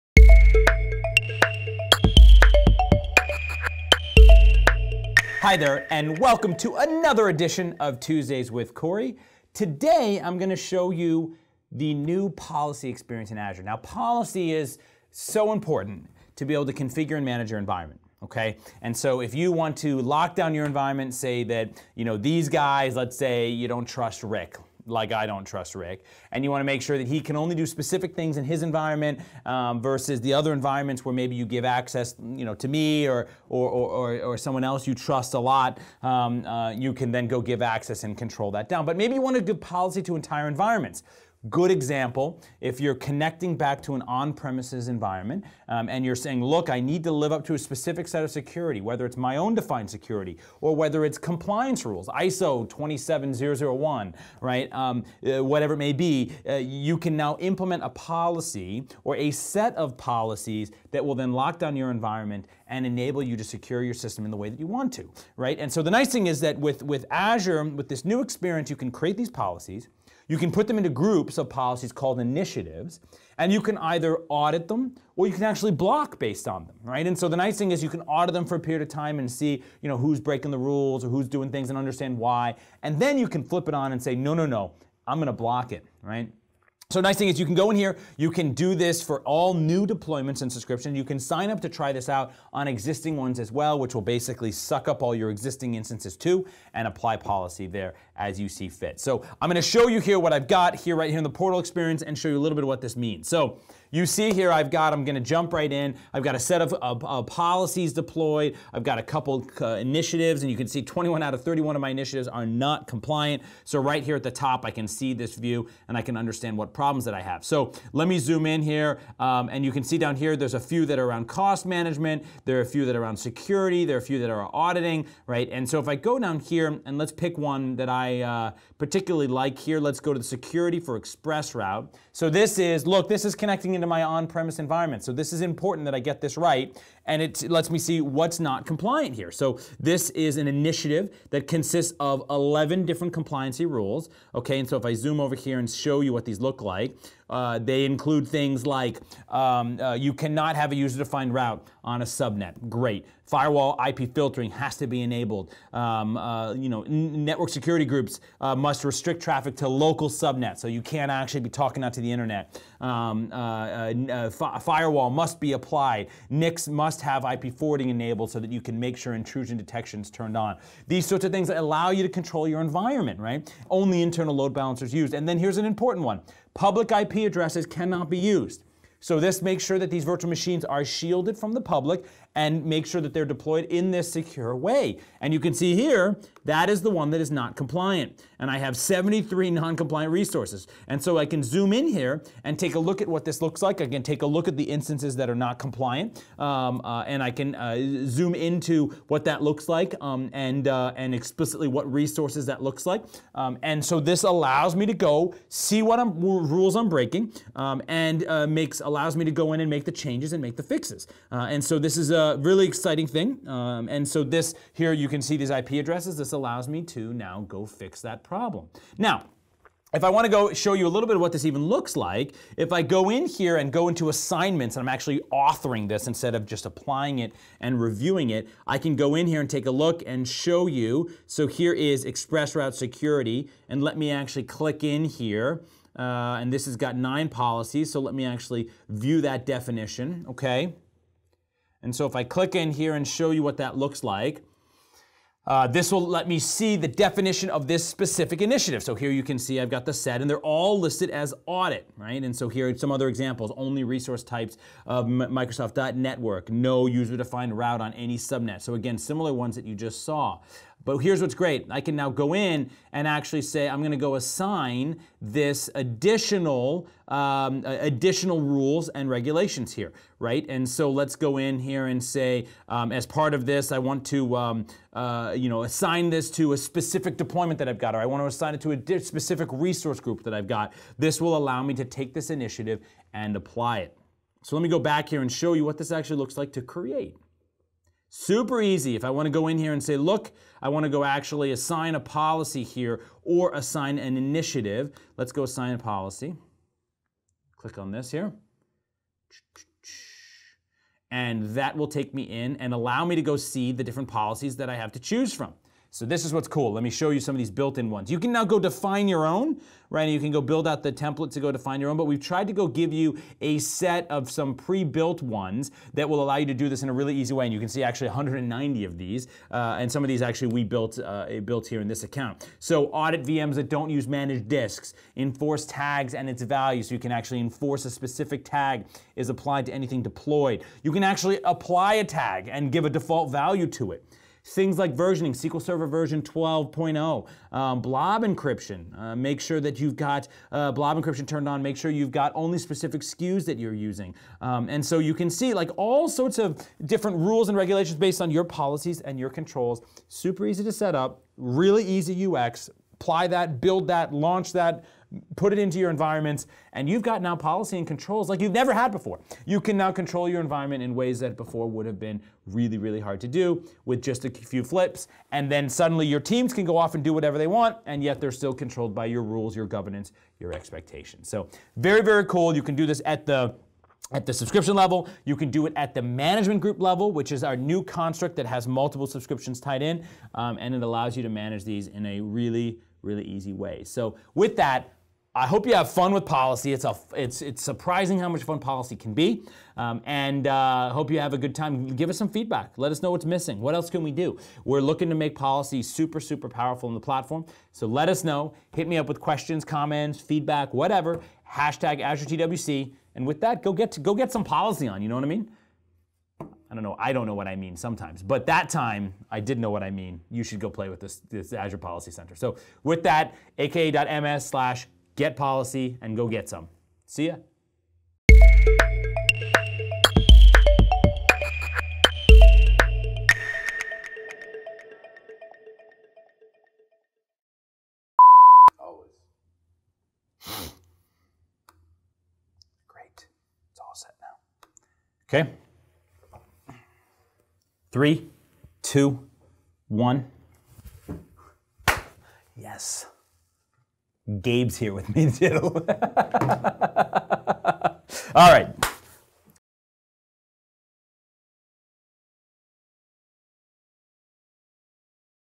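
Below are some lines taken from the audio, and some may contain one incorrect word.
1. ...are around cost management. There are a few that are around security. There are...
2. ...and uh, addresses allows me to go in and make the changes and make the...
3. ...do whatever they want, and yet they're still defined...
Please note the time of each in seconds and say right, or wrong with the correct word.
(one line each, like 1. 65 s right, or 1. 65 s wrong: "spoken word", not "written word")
1. 120 s right
2. 207 s wrong: "makes", not "addresses"
3. 367 s wrong: "controlled", not "defined".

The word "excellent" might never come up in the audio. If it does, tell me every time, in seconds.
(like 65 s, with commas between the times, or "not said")
not said.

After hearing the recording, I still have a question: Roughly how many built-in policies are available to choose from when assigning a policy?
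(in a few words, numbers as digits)
190.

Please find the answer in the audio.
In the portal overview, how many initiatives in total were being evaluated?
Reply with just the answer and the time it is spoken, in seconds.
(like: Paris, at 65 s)
31, at 111 s.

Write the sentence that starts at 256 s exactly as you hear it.
No user-defined route on any subnet.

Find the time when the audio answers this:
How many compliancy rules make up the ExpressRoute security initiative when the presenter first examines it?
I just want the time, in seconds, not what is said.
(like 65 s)
142 s.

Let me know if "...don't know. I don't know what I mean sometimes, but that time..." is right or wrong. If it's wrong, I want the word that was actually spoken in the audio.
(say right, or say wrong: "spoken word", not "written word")
right.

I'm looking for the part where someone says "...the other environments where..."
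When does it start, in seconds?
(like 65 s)
30 s.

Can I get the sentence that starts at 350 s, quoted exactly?
Super easy to set up, really easy UX.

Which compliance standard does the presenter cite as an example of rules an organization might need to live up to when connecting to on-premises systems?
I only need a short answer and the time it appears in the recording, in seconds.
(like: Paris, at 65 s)
ISO 27001, at 52 s.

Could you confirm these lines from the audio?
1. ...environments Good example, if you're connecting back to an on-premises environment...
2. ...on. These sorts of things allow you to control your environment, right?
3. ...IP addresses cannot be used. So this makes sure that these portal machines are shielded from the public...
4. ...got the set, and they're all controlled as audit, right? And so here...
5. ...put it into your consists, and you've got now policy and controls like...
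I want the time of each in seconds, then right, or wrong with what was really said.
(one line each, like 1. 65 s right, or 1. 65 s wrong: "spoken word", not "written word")
1. 40 s right
2. 170 s right
3. 176 s wrong: "virtual", not "portal"
4. 249 s wrong: "listed", not "controlled"
5. 355 s wrong: "environments", not "consists".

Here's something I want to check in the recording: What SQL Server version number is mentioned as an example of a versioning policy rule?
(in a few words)
12.0.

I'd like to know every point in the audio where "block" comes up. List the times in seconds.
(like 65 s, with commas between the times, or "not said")
75 s, 85 s.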